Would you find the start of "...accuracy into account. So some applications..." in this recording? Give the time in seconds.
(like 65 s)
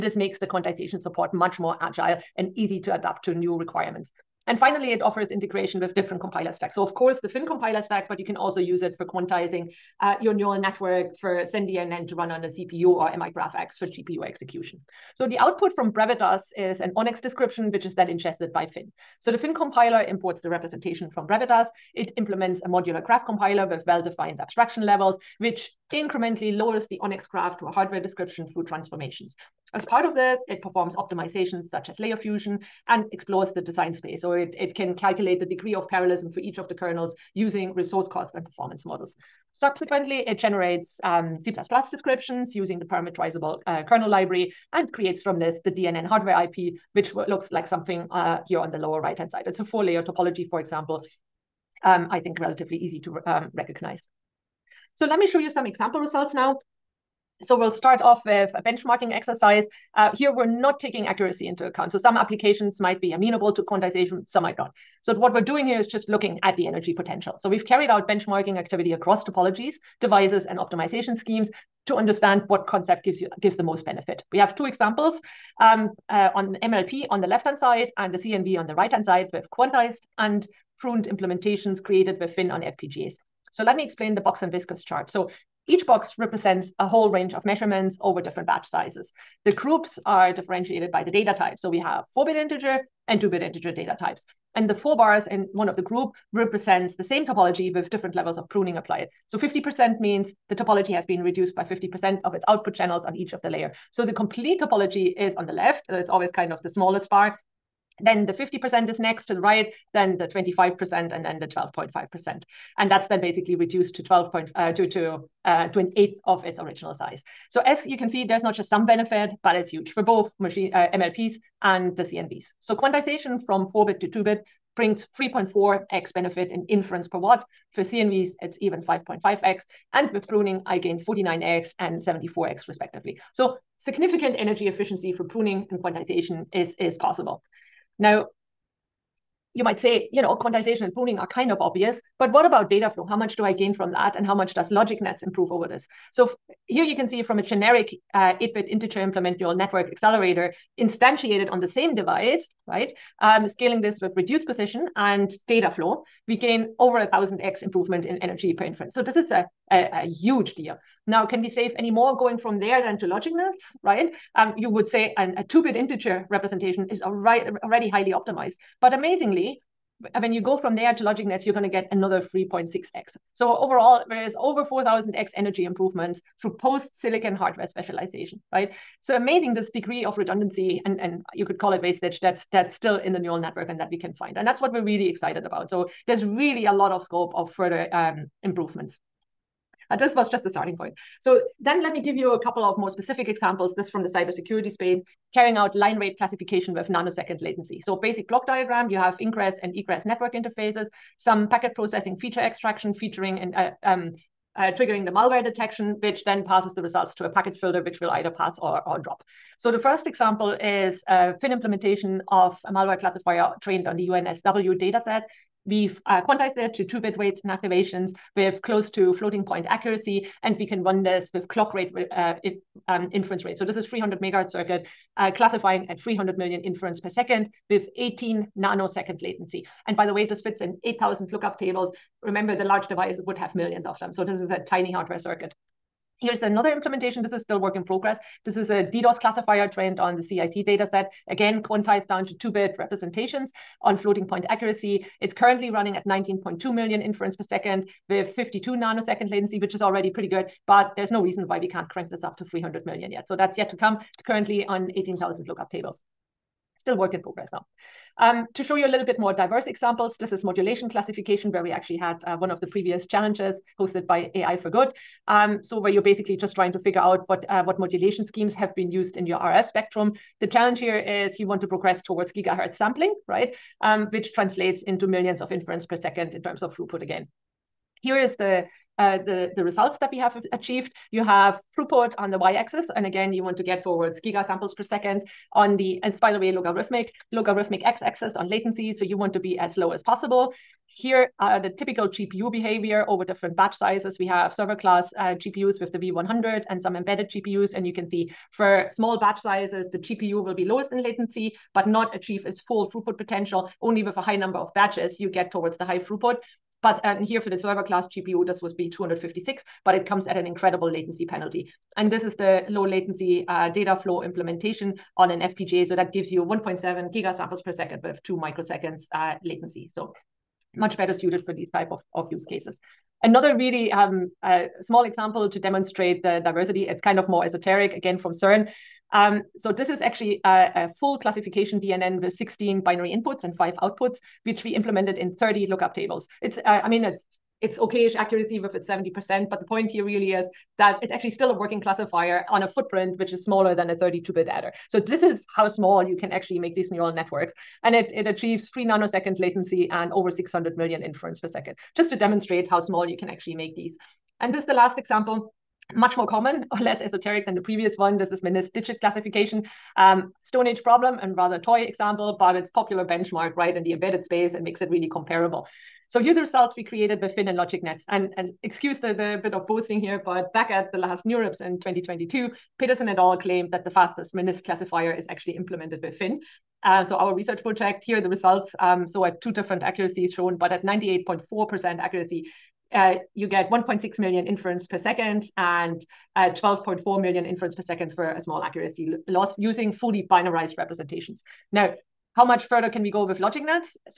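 61 s.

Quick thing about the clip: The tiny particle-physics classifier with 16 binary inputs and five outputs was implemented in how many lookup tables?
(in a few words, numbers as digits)
30.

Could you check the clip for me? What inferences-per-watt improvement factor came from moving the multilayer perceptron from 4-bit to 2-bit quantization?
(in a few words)
3.4x.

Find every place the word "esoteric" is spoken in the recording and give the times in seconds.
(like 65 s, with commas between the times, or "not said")
327 s, 357 s.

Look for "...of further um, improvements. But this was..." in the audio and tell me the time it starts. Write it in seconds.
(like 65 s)
187 s.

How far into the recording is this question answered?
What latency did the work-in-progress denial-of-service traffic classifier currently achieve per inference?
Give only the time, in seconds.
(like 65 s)
248 s.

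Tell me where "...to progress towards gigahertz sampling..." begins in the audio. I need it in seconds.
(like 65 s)
271 s.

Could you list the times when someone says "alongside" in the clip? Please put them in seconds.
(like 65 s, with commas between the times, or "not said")
not said.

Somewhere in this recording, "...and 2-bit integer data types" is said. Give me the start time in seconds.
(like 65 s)
93 s.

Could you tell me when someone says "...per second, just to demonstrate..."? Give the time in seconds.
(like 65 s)
351 s.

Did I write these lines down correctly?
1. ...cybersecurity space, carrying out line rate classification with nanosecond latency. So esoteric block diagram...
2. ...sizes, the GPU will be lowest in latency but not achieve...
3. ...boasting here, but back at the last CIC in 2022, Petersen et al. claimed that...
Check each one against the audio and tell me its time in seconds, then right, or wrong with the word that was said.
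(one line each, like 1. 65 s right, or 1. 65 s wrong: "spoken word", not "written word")
1. 194 s wrong: "basic", not "esoteric"
2. 299 s right
3. 369 s wrong: "NeurIPS", not "CIC".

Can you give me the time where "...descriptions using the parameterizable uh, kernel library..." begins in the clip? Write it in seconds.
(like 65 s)
41 s.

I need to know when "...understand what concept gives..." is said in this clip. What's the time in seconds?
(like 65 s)
71 s.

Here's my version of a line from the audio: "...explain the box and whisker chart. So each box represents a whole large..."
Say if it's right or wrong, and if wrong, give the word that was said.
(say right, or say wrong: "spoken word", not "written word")
wrong: "range", not "large".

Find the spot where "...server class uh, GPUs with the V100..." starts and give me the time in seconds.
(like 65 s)
294 s.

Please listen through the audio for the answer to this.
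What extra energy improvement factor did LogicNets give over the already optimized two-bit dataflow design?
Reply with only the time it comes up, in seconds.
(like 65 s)
172 s.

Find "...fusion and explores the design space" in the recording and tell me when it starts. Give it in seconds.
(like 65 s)
32 s.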